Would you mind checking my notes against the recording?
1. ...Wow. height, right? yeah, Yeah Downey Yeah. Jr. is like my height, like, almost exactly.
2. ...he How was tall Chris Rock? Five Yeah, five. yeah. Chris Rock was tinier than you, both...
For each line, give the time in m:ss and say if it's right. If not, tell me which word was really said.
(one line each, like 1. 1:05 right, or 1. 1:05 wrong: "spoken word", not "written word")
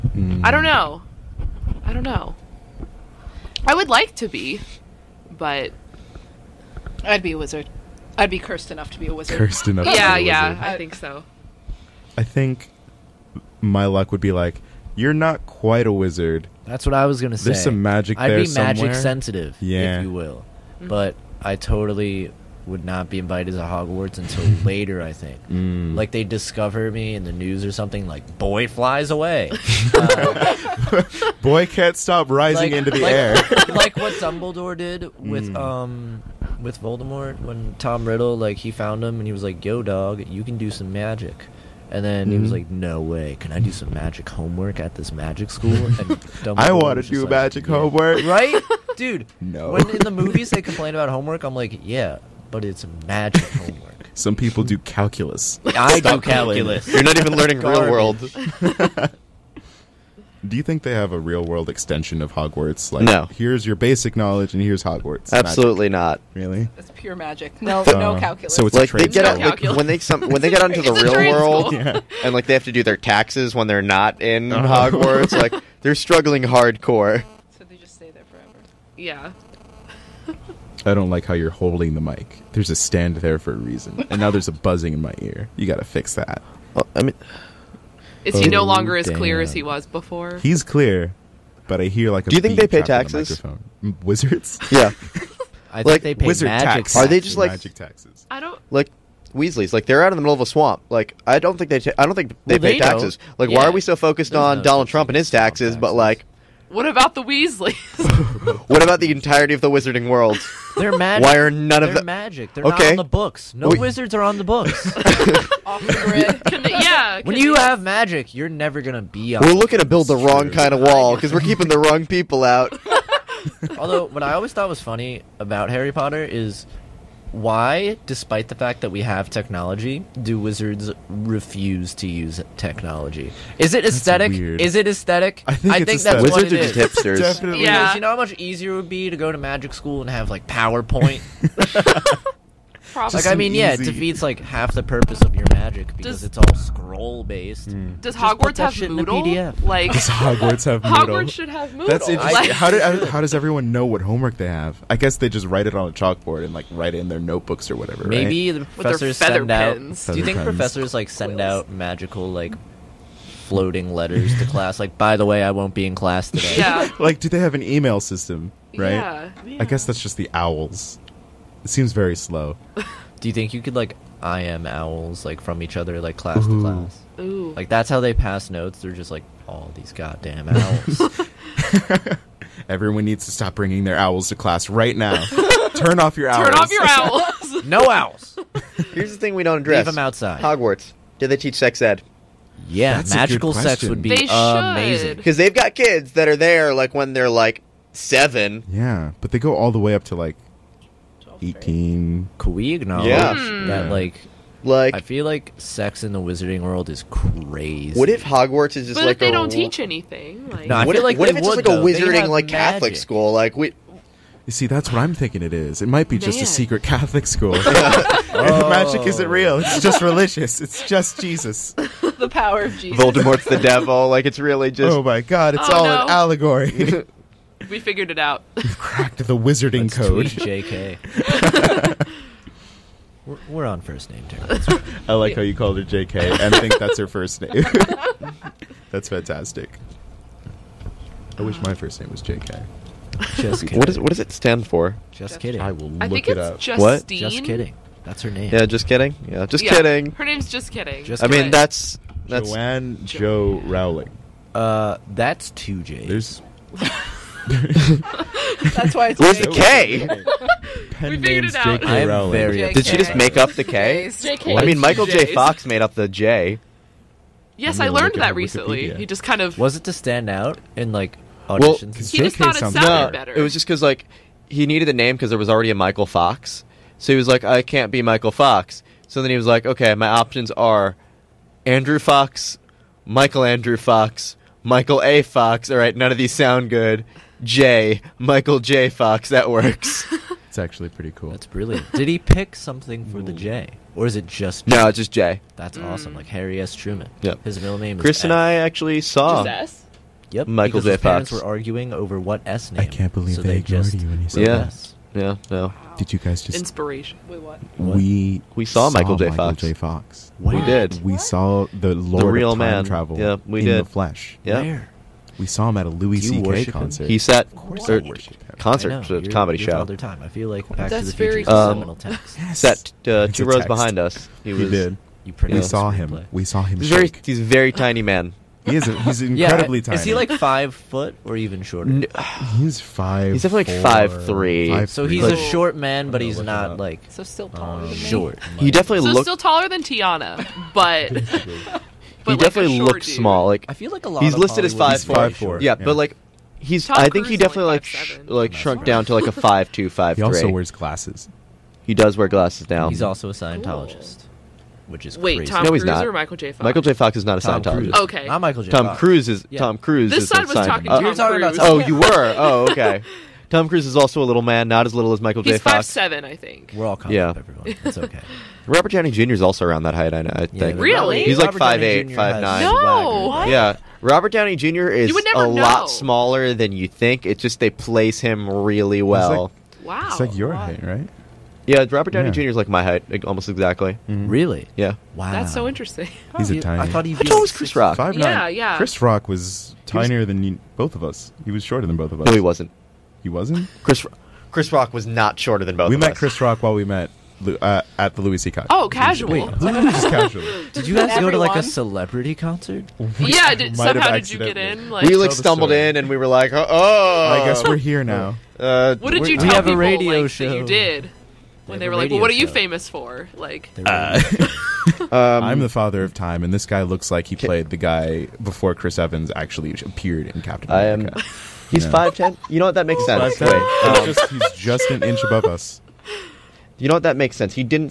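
1. 6:20 wrong: "Robert", not "Yeah"
2. 6:27 wrong: "nine", not "five".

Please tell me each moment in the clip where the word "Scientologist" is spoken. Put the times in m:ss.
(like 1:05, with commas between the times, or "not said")
5:53, 5:57.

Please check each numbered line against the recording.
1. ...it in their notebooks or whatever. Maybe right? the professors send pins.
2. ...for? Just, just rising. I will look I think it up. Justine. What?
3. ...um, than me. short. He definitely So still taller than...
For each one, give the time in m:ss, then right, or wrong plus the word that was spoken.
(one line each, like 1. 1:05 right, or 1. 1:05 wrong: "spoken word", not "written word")
1. 2:36 right
2. 4:04 wrong: "kidding", not "rising"
3. 5:37 right.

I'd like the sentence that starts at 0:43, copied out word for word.
Can I do some magic homework at this magic school?" I want to do like, magic yeah.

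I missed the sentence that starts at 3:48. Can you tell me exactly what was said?
We've cracked the wizarding Let's code.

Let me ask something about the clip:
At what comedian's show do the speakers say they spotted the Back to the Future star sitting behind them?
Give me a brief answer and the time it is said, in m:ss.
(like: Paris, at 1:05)
Louis C.K., at 5:15.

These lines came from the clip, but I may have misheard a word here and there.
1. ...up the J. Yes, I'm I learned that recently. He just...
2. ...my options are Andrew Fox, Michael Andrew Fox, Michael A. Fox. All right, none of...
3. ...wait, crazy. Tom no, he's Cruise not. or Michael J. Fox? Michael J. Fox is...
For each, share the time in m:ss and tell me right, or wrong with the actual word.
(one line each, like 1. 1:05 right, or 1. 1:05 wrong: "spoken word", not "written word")
1. 4:25 right
2. 4:39 right
3. 5:55 right.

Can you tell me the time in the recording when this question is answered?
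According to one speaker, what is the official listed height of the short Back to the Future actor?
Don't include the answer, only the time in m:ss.
5:44.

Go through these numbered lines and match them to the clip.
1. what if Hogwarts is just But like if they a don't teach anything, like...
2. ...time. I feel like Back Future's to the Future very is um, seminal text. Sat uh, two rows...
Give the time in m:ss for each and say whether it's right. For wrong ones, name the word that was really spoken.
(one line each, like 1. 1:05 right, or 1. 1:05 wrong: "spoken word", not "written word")
1. 3:27 right
2. 5:19 wrong: "That", not "Future".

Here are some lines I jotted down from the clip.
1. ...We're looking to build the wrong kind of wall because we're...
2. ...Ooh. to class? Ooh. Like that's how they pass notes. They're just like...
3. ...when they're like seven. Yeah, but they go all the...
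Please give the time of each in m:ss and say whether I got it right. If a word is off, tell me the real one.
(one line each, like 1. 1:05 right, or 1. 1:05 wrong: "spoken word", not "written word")
1. 1:59 right
2. 2:56 right
3. 3:16 right.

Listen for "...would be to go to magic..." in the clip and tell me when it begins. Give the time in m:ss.
2:18.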